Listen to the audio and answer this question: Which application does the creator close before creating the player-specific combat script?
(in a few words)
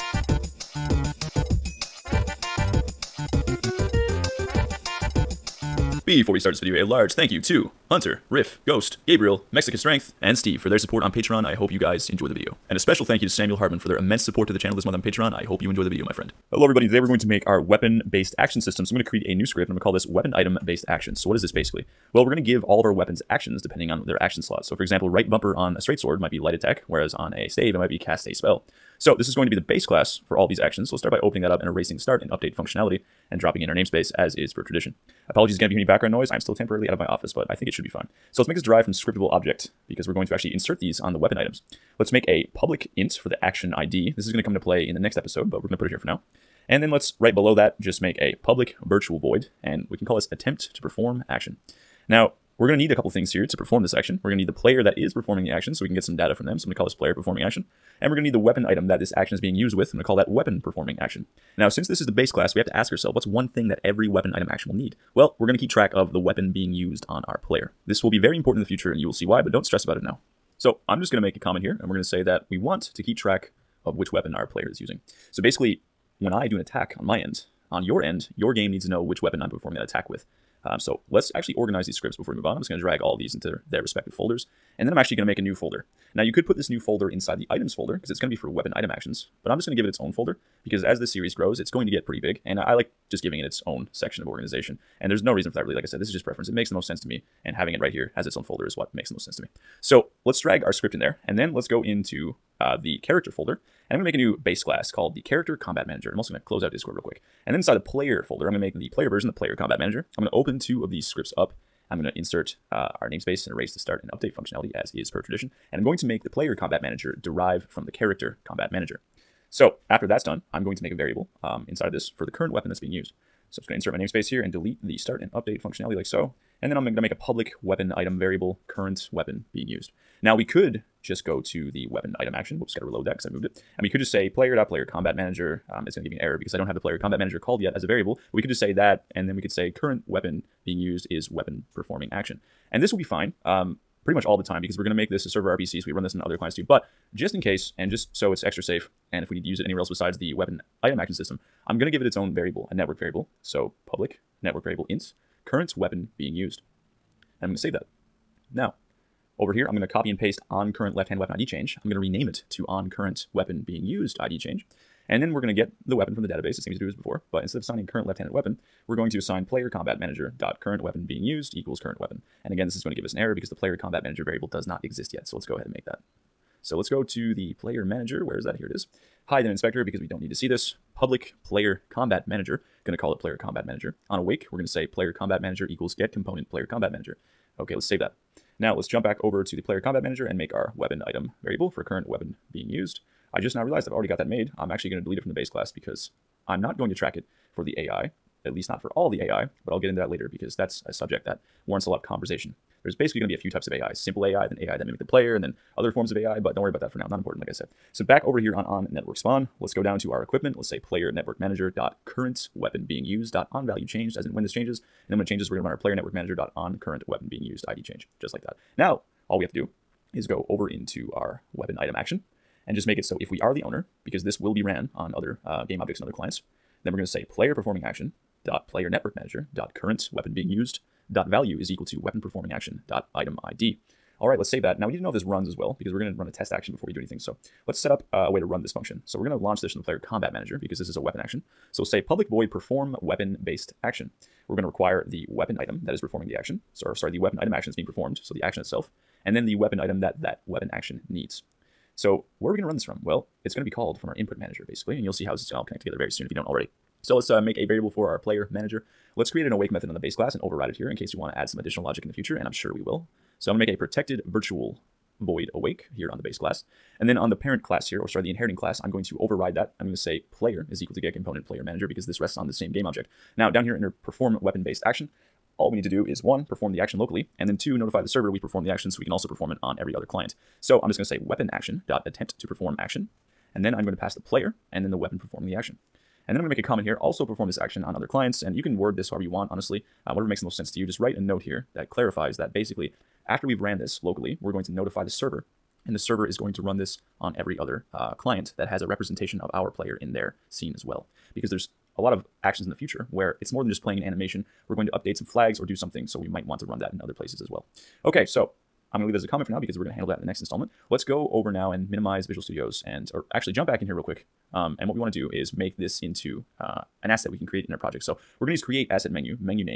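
Discord.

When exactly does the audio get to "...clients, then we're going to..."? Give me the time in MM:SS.
03:46.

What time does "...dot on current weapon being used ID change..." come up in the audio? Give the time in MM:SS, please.
03:36.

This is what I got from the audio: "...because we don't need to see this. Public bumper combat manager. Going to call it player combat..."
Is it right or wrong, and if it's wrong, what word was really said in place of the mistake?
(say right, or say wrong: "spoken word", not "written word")
wrong: "player", not "bumper".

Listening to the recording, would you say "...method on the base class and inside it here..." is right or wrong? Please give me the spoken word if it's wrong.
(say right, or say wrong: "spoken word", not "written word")
wrong: "override", not "inside".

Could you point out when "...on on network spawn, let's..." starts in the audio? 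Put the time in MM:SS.
03:28.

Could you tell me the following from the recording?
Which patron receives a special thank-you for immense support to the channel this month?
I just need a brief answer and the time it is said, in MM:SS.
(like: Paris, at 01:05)
Samuel Hartman, at 00:13.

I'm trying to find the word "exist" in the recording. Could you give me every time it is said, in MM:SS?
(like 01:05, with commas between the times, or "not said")
02:54.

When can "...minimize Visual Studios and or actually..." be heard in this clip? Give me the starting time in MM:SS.
05:11.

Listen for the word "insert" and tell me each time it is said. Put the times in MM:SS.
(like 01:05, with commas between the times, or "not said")
00:40, 01:52, 02:03.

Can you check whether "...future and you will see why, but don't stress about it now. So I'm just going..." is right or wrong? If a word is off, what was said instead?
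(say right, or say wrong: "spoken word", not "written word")
right.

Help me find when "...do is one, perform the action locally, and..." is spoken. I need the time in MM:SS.
04:35.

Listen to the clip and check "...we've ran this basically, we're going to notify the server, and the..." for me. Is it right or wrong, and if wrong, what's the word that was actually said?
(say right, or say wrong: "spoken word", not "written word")
wrong: "locally", not "basically".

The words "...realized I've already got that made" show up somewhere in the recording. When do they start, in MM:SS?
03:13.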